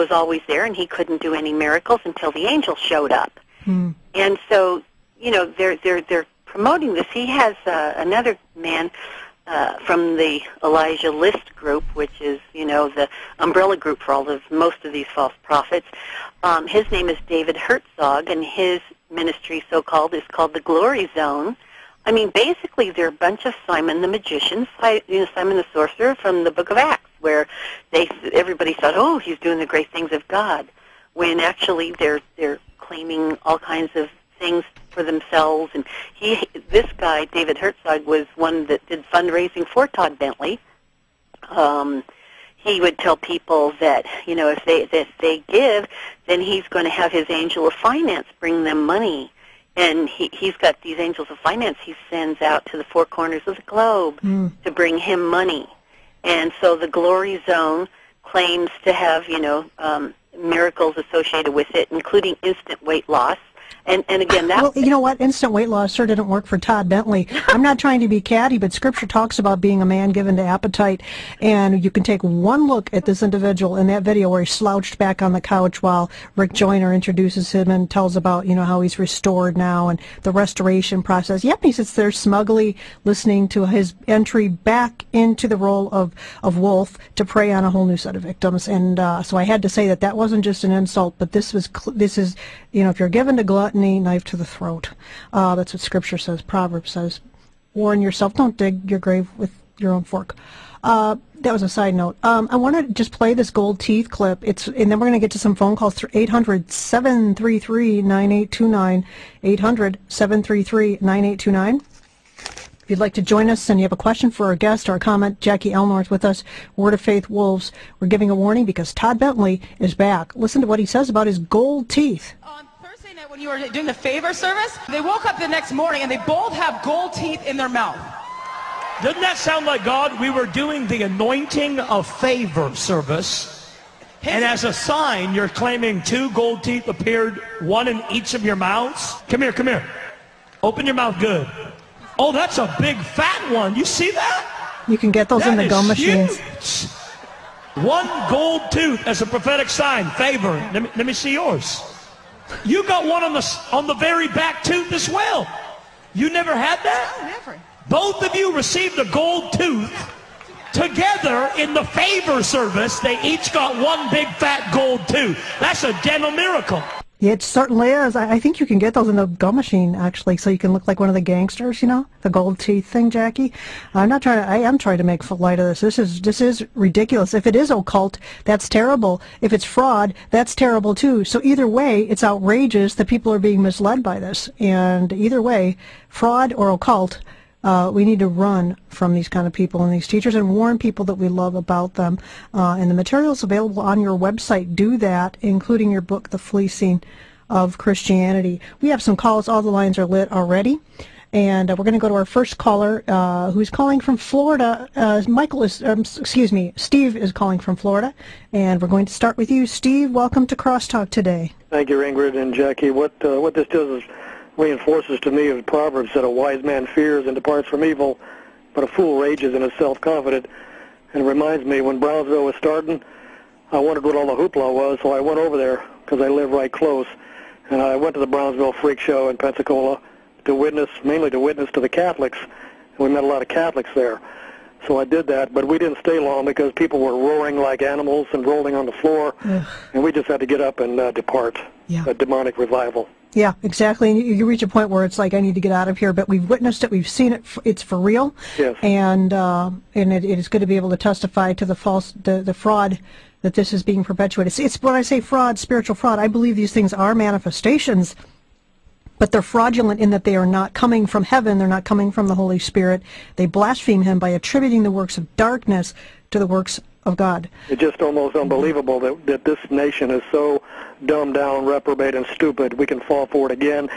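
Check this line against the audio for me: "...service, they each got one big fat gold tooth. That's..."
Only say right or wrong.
right.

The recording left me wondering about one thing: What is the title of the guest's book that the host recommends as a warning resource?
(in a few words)
The Fleecing of Christianity.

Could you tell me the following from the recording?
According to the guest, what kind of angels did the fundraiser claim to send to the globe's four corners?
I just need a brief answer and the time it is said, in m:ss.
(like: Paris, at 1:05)
angels of finance, at 0:51.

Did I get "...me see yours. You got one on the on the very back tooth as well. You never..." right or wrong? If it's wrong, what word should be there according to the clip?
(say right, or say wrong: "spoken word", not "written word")
right.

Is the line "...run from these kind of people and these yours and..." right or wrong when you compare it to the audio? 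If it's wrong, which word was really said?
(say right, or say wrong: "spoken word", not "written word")
wrong: "teachers", not "yours".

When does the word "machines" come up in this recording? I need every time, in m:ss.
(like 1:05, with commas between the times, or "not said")
2:25, 2:49.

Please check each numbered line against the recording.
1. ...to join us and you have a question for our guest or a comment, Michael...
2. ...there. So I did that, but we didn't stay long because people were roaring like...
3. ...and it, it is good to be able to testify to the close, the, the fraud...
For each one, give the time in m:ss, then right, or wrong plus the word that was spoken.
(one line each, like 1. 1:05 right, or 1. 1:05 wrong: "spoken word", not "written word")
1. 1:53 wrong: "Jackie", not "Michael"
2. 3:53 right
3. 4:09 wrong: "false", not "close".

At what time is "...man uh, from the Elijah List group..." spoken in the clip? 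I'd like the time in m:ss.
0:08.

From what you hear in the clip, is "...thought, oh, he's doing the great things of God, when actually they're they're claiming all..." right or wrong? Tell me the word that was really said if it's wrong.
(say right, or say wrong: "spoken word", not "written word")
right.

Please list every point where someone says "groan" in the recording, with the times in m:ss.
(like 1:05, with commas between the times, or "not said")
not said.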